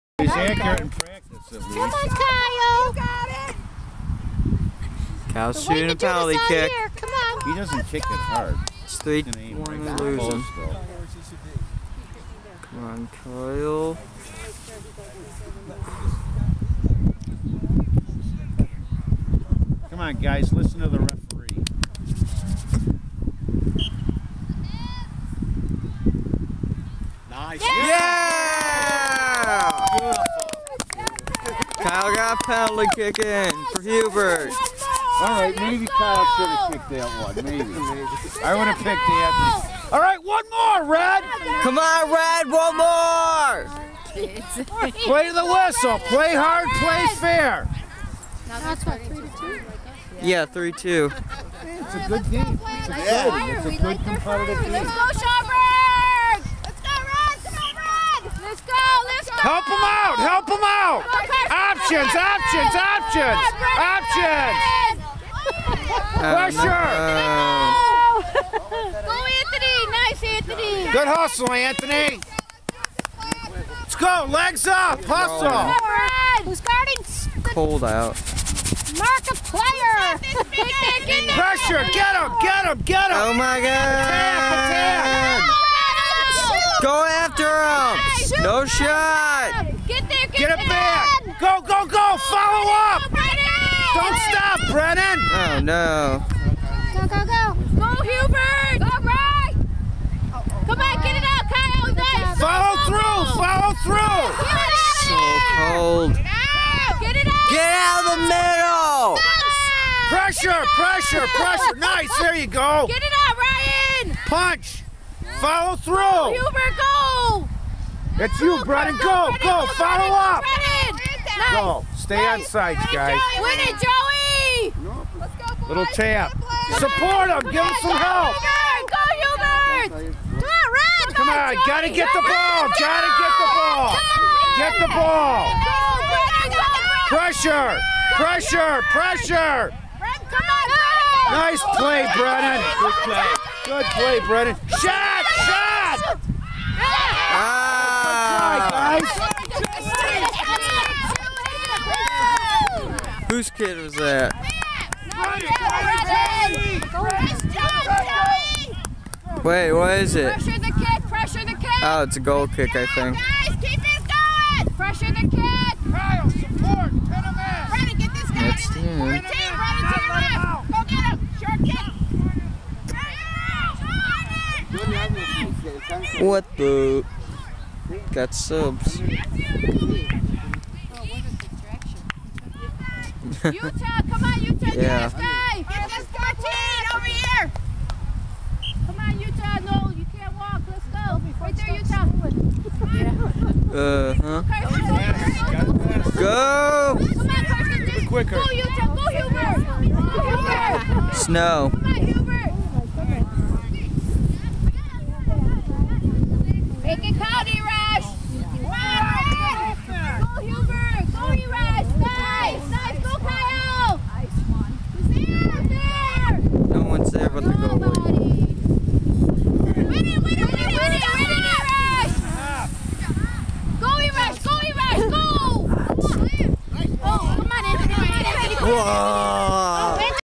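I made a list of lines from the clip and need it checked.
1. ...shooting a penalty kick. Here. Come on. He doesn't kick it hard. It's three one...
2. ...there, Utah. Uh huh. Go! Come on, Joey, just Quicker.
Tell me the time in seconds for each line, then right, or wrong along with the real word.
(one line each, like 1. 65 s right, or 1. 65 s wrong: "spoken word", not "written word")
1. 5 s right
2. 191 s wrong: "Carson", not "Joey".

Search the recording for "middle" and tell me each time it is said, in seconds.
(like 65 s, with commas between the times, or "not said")
109 s.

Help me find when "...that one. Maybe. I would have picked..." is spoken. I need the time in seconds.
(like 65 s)
36 s.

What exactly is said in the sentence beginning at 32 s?
half pound leg kick in for Hubert.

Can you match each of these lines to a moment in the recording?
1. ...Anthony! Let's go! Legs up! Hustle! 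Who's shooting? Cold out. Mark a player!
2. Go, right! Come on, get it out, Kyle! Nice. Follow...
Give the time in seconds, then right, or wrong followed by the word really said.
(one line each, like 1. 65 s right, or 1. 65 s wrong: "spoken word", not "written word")
1. 71 s wrong: "guarding", not "shooting"
2. 98 s right.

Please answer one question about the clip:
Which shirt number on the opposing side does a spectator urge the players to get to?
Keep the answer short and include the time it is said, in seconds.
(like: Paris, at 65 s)
14, at 186 s.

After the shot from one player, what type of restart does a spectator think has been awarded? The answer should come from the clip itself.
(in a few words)
Goal kick.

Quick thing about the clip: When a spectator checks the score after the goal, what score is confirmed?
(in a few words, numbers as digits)
3-2.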